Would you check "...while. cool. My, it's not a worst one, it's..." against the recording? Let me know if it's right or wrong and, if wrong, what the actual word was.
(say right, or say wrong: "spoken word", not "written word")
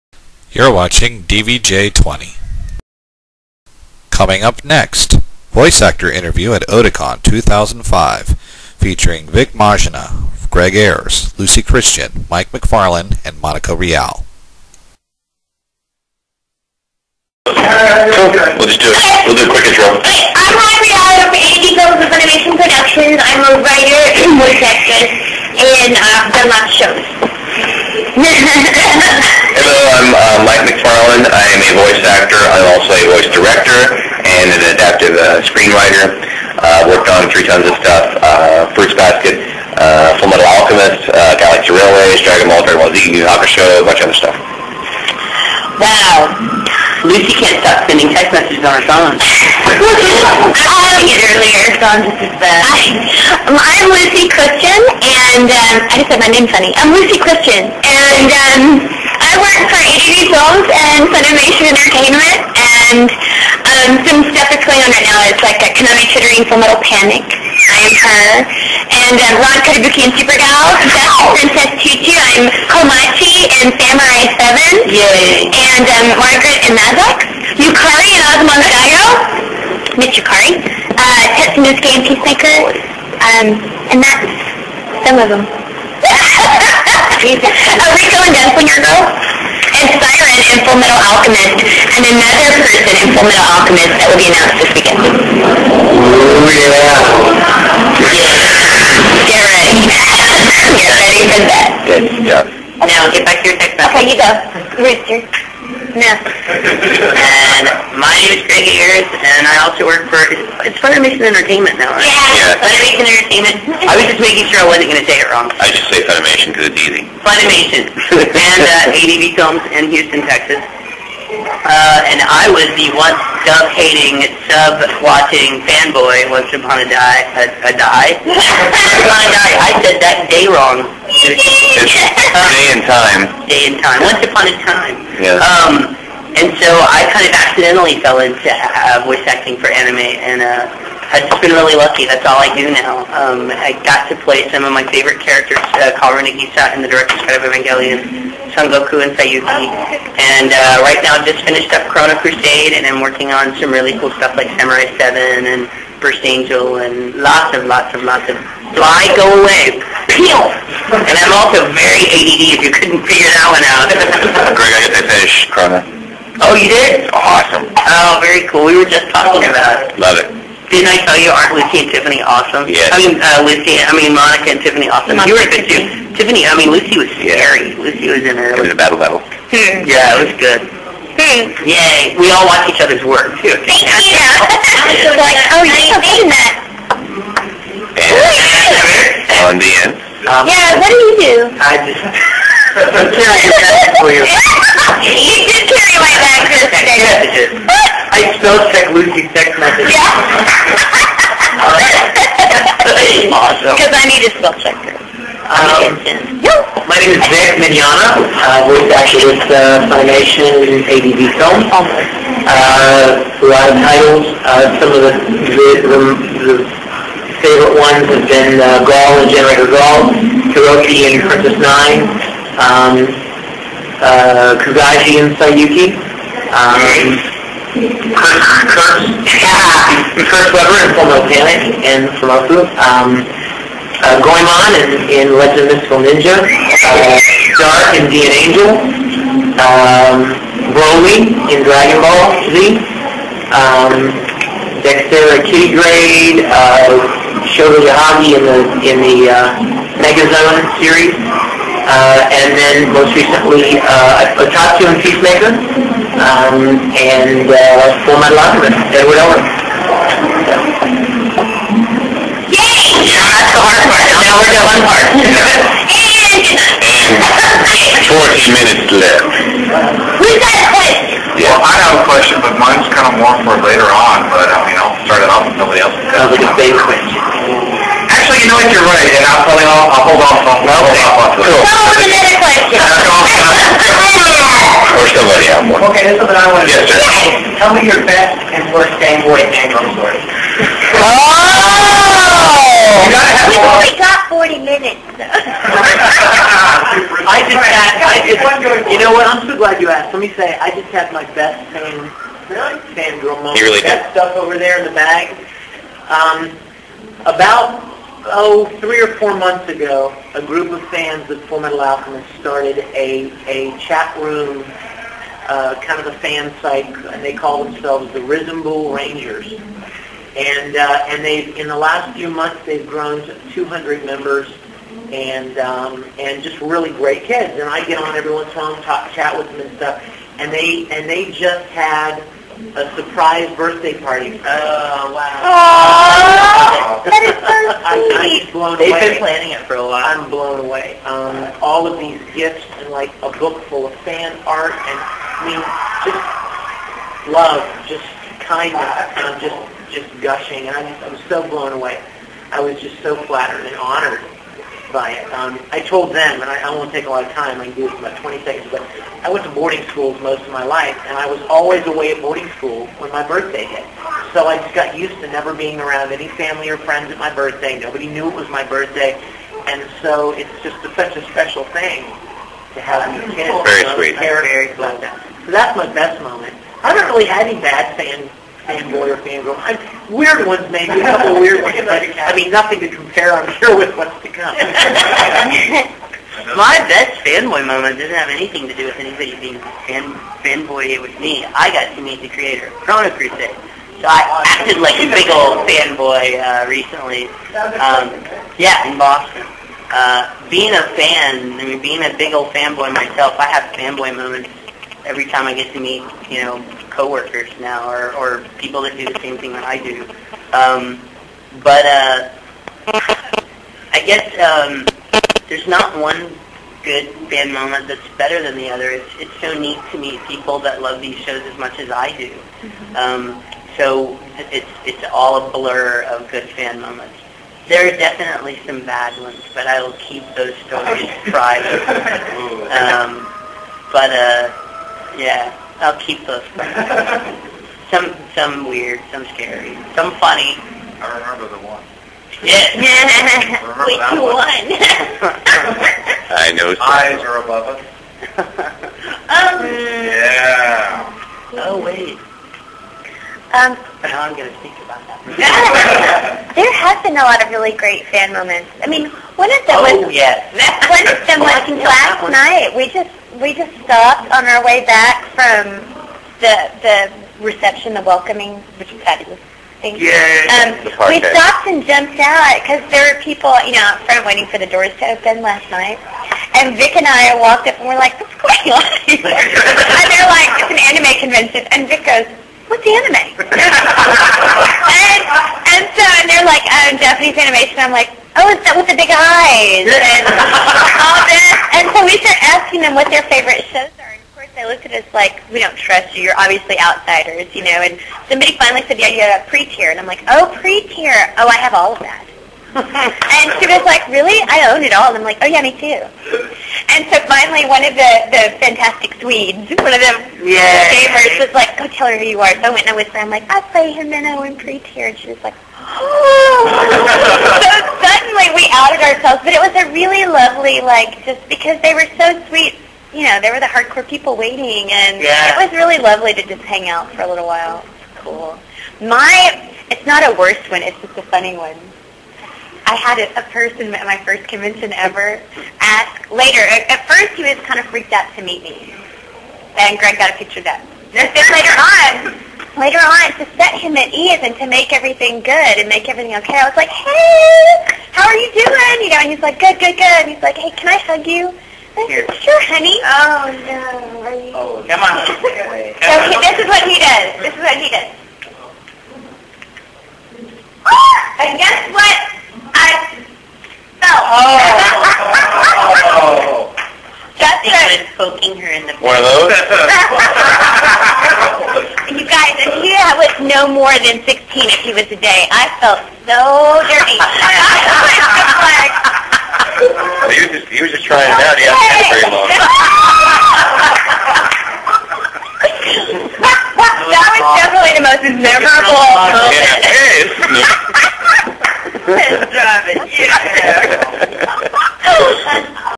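right.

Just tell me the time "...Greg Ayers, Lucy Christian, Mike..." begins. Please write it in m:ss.
0:10.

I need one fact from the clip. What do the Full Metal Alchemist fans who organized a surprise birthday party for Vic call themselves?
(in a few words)
Bull Rangers.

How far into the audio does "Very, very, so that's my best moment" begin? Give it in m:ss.
6:14.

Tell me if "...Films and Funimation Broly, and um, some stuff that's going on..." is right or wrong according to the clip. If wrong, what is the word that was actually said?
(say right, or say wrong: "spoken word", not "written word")
wrong: "Entertainment", not "Broly".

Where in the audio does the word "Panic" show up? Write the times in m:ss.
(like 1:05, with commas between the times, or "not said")
1:06, 3:51.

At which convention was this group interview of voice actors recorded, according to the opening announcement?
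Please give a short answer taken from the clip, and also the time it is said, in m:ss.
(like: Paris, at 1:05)
Oticon 2005, at 0:06.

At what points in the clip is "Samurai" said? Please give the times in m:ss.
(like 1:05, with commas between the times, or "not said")
1:13, 2:34.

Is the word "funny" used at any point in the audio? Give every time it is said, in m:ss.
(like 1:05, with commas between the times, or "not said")
0:56, 7:20, 8:51.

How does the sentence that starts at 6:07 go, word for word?
Nobody knew it was my birthday.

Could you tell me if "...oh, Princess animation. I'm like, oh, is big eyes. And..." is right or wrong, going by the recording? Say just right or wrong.
wrong.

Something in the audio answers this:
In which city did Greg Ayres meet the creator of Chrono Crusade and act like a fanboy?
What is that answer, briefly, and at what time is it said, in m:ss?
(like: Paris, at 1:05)
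Boston, at 6:38.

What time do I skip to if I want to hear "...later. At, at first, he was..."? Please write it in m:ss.
8:56.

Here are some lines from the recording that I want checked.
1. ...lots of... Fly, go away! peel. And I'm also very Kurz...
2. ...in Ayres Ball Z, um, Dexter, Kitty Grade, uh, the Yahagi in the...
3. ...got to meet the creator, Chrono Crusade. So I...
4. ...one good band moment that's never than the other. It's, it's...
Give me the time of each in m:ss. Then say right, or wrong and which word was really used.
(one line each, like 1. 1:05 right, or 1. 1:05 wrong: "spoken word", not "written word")
1. 2:38 wrong: "ADD", not "Kurz"
2. 4:01 wrong: "Dragon", not "Ayres"
3. 6:31 right
4. 6:55 wrong: "better", not "never".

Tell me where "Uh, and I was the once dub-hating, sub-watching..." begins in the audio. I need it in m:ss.
2:01.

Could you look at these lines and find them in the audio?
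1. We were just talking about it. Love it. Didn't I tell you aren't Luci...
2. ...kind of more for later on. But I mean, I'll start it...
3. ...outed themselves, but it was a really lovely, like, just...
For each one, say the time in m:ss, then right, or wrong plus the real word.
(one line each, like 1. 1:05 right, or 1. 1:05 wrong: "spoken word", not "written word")
1. 2:48 right
2. 4:32 right
3. 8:38 wrong: "ourselves", not "themselves".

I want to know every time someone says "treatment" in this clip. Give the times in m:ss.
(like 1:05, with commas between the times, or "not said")
not said.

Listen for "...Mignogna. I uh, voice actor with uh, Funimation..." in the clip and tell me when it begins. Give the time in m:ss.
3:27.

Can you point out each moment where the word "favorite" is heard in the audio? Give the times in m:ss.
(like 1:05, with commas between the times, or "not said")
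2:24, 3:37, 8:13.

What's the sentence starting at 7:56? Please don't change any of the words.
And Vic and I walked up and we're like, what's going on?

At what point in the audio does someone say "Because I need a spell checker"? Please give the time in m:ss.
3:23.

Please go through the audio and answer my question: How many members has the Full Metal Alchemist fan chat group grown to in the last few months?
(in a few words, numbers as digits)
200.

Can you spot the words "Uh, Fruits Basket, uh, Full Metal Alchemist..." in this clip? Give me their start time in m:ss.
0:38.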